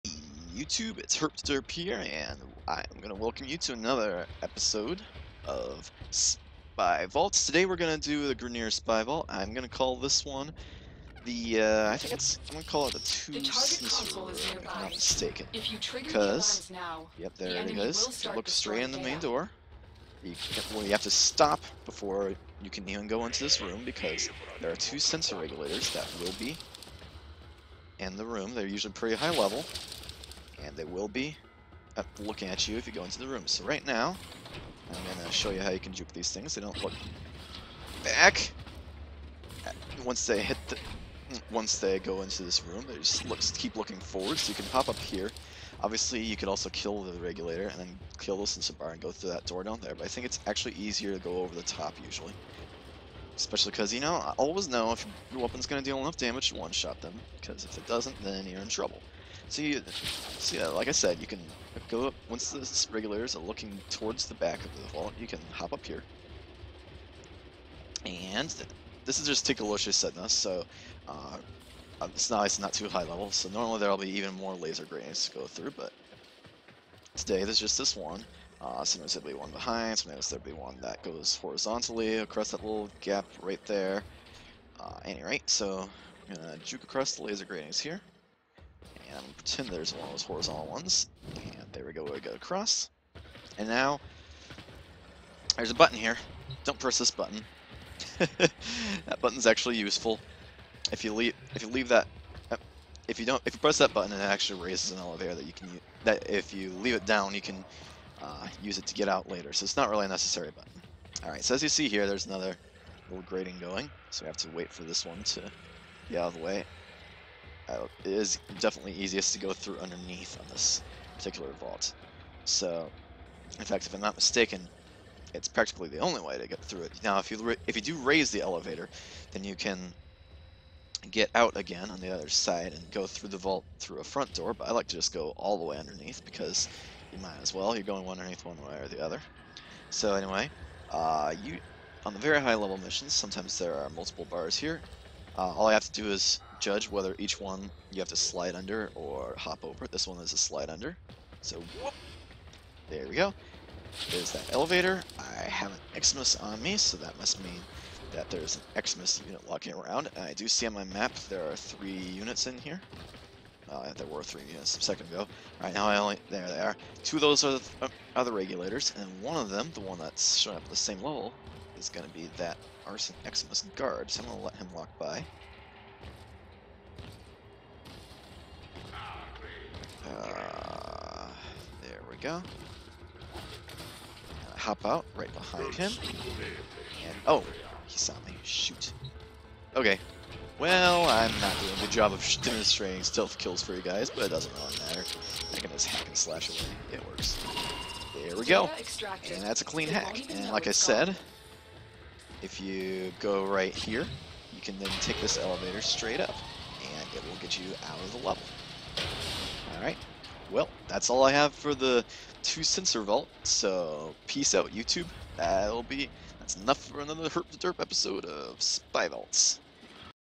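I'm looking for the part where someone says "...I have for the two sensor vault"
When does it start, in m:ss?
3:31.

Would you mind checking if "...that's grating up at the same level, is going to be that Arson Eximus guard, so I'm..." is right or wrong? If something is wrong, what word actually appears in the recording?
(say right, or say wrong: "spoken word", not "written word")
wrong: "showing", not "grating".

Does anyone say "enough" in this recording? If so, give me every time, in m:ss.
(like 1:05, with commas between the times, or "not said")
0:55, 3:36.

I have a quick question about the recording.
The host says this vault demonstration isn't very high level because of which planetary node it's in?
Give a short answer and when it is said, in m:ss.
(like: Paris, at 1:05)
Tikalosha, at 1:09.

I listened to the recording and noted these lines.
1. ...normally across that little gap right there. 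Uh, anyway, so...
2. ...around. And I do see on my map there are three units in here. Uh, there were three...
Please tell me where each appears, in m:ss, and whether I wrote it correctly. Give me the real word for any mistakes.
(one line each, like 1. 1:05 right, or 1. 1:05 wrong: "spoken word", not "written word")
1. 1:21 wrong: "horizontally", not "normally"
2. 2:39 right.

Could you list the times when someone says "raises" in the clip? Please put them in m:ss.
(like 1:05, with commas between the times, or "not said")
1:44, 2:07.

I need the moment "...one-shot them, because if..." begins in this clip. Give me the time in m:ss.
0:56.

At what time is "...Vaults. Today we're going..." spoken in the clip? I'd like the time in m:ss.
0:07.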